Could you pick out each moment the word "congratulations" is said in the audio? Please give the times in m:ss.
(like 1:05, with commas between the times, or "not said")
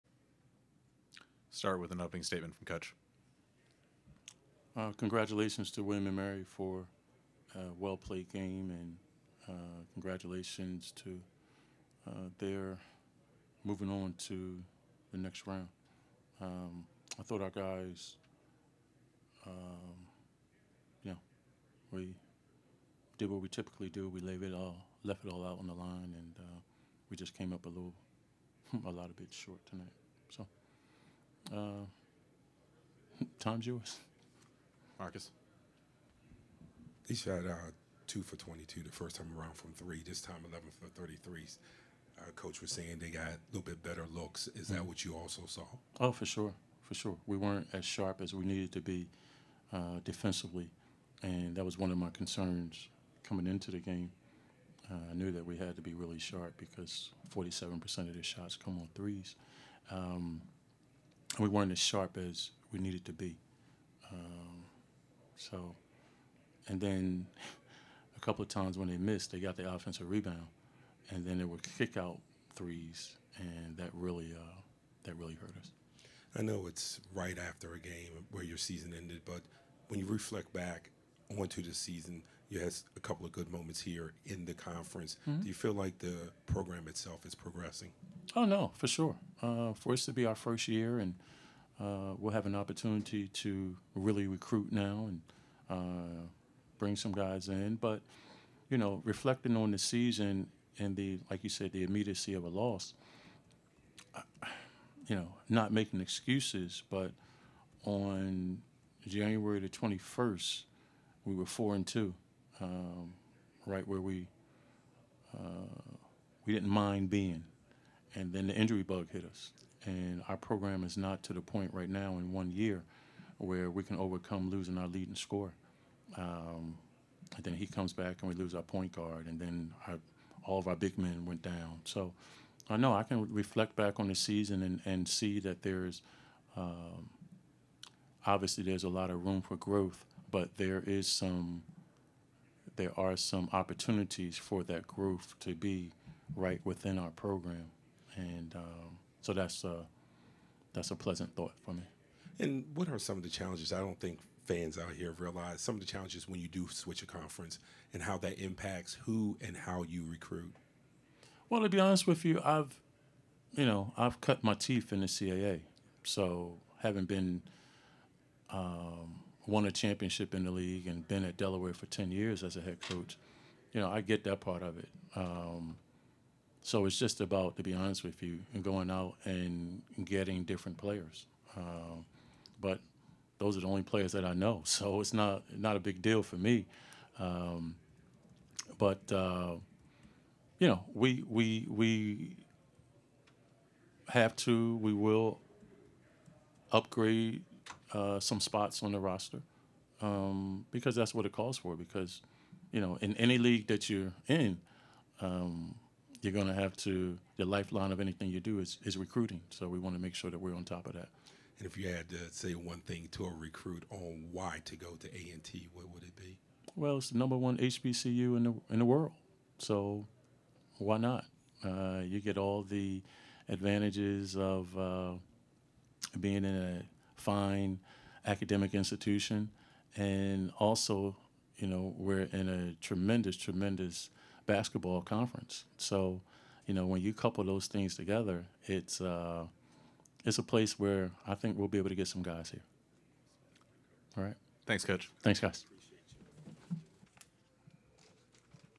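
0:04, 0:09.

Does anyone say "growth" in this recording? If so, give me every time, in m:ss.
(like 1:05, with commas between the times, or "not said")
2:19, 2:24.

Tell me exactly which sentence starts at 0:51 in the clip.
And that was one of my concerns coming into the game.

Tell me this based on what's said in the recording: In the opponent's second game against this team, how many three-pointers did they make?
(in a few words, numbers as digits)
11.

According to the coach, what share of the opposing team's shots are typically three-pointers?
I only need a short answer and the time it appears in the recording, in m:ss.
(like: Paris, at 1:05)
47%, at 0:57.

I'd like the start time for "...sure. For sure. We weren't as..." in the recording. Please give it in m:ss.
0:46.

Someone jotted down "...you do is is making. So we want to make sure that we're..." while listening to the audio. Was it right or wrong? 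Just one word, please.
wrong.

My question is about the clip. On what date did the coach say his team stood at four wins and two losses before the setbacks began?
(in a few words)
January 21.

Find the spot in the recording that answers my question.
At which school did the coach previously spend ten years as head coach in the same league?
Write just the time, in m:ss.
2:51.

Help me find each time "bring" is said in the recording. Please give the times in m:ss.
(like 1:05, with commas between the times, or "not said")
1:36.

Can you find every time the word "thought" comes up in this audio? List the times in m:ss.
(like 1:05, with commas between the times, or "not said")
0:17, 2:31.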